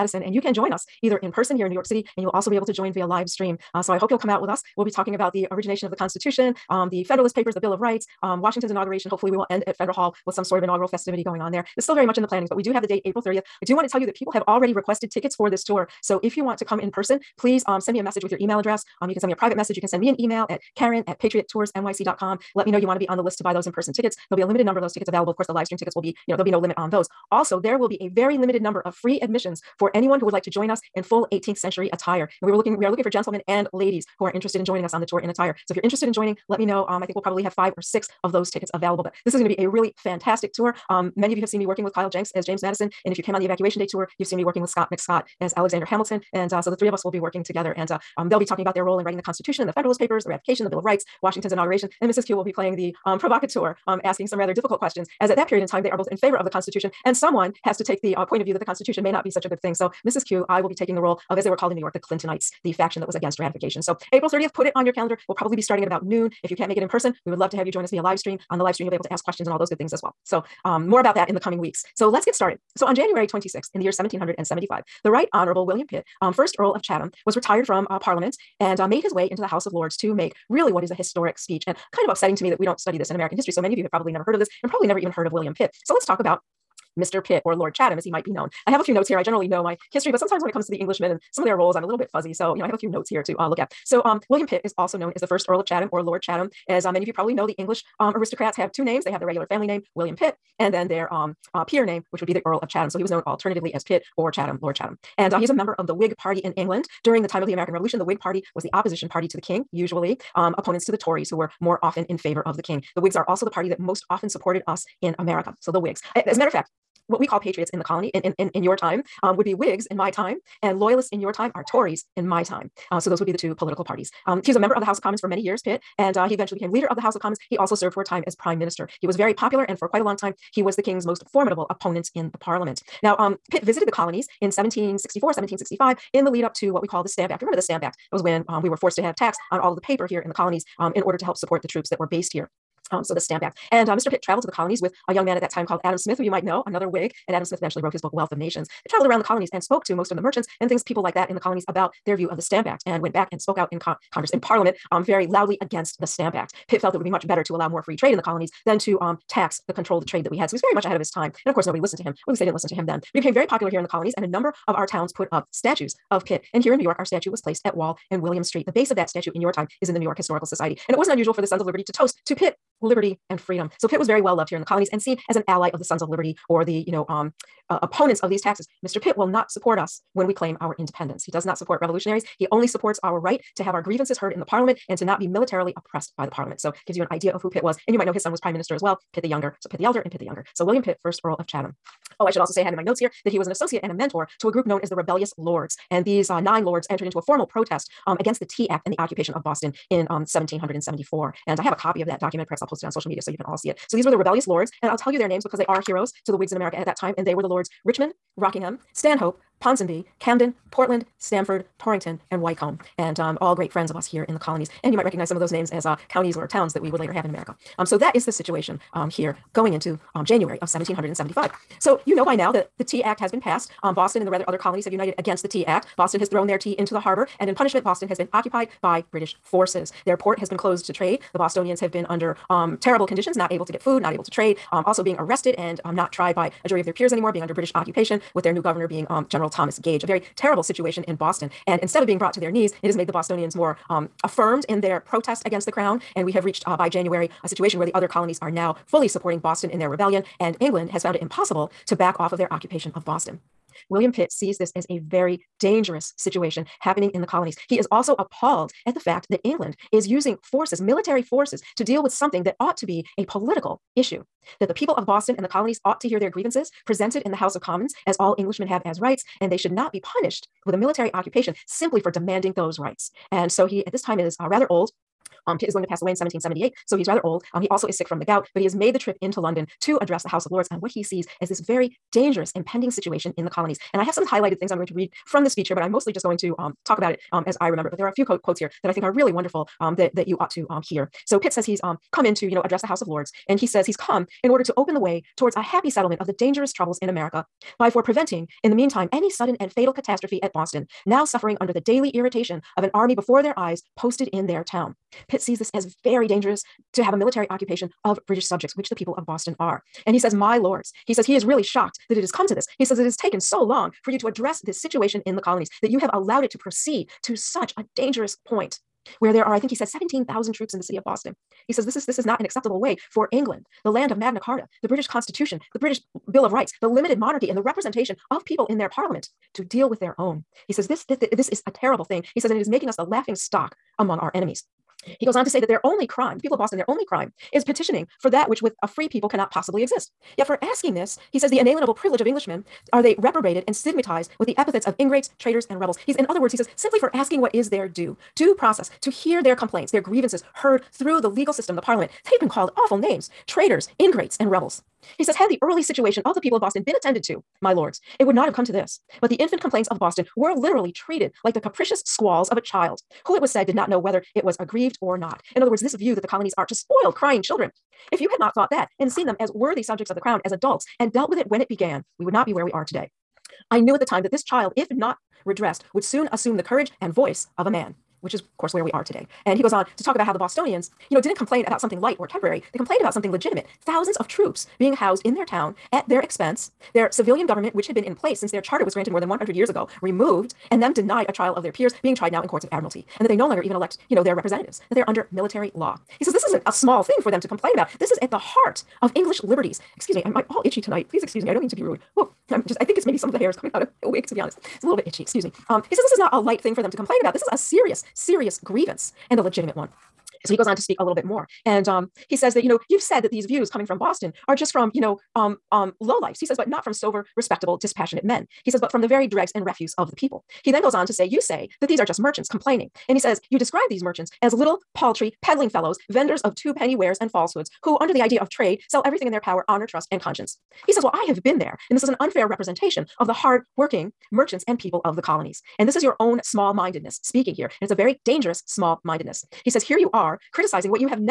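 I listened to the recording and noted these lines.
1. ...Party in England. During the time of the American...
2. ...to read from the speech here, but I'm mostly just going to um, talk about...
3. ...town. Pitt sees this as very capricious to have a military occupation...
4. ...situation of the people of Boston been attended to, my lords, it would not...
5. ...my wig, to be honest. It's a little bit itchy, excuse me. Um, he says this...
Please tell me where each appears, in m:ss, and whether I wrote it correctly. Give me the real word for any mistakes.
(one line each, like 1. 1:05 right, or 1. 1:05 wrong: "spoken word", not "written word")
1. 1:46 right
2. 4:44 right
3. 5:04 wrong: "dangerous", not "capricious"
4. 5:55 right
5. 6:44 right.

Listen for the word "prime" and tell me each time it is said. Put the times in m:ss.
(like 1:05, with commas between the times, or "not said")
2:08, 3:08.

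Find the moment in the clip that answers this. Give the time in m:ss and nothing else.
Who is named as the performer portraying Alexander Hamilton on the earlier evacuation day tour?
0:44.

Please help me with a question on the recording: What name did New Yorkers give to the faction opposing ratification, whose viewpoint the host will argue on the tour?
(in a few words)
the Clintonites.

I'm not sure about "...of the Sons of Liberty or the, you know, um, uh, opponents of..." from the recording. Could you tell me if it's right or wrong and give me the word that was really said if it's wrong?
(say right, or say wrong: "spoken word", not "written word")
right.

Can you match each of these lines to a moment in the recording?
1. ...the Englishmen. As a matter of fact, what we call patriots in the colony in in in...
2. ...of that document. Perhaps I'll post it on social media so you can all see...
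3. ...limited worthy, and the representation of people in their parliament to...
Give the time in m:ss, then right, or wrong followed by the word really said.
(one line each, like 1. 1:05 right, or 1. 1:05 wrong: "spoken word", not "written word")
1. 1:55 wrong: "Whigs", not "Englishmen"
2. 3:22 right
3. 5:26 wrong: "monarchy", not "worthy".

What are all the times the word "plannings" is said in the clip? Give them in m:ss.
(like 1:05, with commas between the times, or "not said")
0:12.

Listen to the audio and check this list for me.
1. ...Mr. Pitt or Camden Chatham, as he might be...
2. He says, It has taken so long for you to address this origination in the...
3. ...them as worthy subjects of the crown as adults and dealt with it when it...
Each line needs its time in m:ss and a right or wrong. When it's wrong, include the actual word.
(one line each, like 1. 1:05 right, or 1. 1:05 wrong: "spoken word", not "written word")
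1. 1:26 wrong: "Lord", not "Camden"
2. 5:12 wrong: "situation", not "origination"
3. 6:09 right.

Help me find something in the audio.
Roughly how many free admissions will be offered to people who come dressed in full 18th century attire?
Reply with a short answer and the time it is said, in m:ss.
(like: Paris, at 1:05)
5 or 6, at 0:37.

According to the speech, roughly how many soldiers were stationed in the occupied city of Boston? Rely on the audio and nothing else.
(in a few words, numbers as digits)
17,000.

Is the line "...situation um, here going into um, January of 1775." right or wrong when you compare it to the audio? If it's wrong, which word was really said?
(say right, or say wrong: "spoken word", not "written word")
right.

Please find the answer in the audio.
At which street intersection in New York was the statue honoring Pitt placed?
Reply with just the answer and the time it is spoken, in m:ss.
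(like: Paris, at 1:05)
Wall and William Street, at 2:47.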